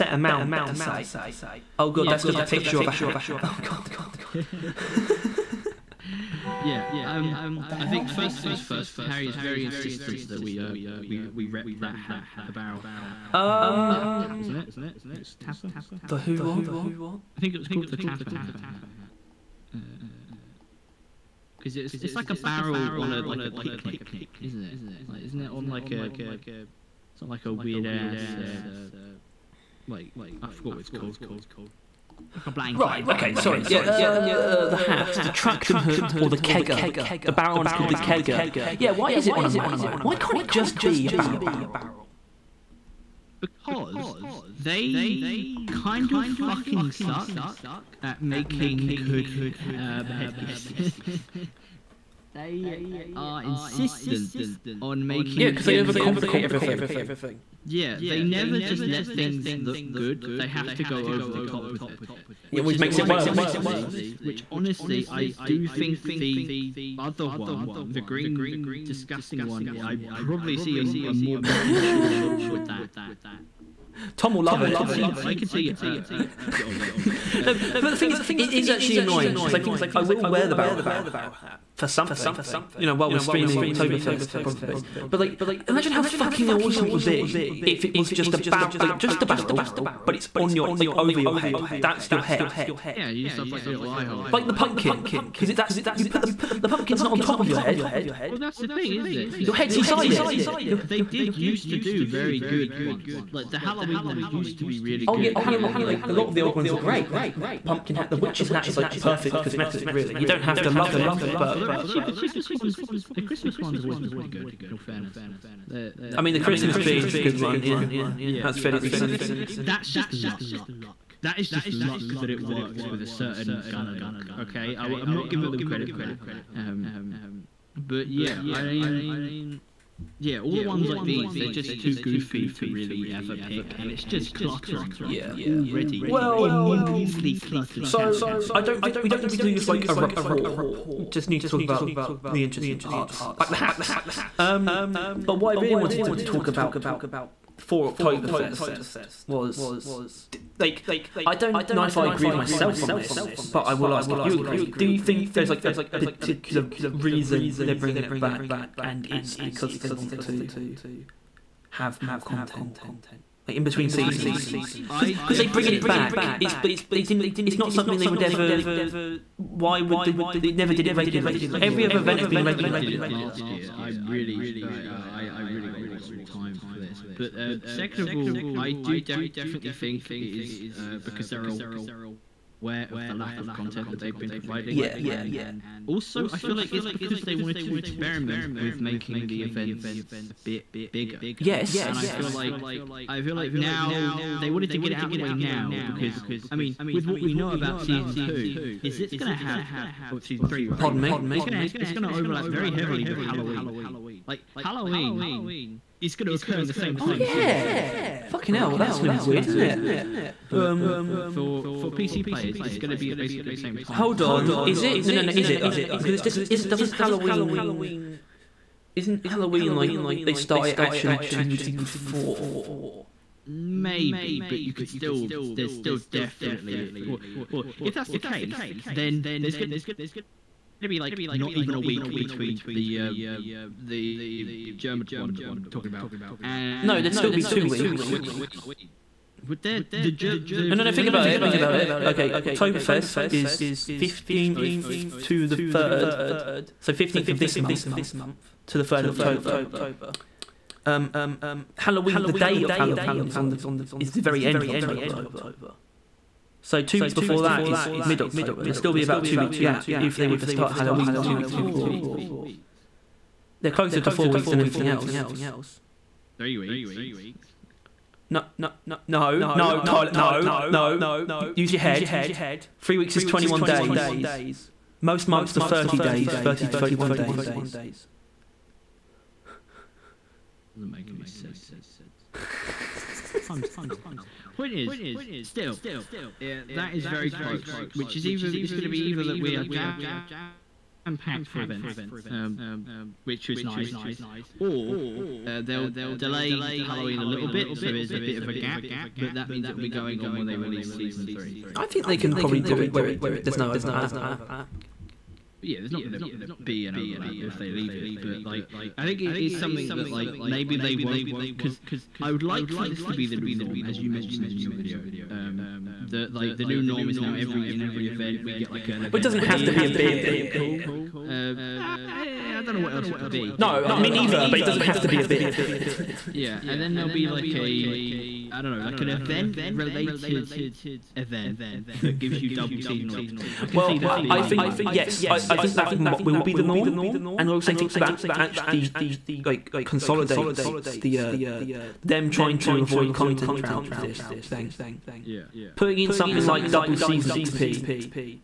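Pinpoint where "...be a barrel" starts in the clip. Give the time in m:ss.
0:40.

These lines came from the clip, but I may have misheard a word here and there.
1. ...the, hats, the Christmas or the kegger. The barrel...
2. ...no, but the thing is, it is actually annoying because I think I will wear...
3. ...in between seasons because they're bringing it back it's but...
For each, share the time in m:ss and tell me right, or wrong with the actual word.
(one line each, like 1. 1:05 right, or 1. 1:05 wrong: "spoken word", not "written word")
1. 0:34 wrong: "Trachtenhut", not "Christmas"
2. 1:17 right
3. 2:43 right.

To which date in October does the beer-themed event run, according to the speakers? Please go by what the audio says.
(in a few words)
3rd of October.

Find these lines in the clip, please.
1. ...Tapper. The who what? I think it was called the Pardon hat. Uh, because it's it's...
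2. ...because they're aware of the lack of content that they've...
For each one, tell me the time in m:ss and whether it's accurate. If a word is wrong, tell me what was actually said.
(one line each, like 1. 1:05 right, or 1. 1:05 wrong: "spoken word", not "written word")
1. 0:15 wrong: "Tapper", not "Pardon"
2. 3:00 right.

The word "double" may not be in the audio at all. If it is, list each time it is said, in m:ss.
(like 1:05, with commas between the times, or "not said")
5:32, 5:46.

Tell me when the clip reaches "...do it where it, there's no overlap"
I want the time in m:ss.
5:02.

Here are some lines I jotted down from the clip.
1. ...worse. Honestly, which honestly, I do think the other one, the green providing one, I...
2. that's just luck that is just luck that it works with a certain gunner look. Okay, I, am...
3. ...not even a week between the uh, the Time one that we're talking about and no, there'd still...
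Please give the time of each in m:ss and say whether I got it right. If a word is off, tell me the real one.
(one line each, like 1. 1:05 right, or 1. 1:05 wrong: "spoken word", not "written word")
1. 1:03 wrong: "disgusting", not "providing"
2. 1:59 right
3. 3:51 wrong: "German", not "Time".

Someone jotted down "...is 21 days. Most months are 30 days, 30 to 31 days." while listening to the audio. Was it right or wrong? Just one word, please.
right.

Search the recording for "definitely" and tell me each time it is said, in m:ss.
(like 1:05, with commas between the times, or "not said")
2:58, 3:46.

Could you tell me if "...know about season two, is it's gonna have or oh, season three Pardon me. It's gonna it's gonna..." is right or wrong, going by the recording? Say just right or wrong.
right.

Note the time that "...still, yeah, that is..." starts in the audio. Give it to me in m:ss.
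4:45.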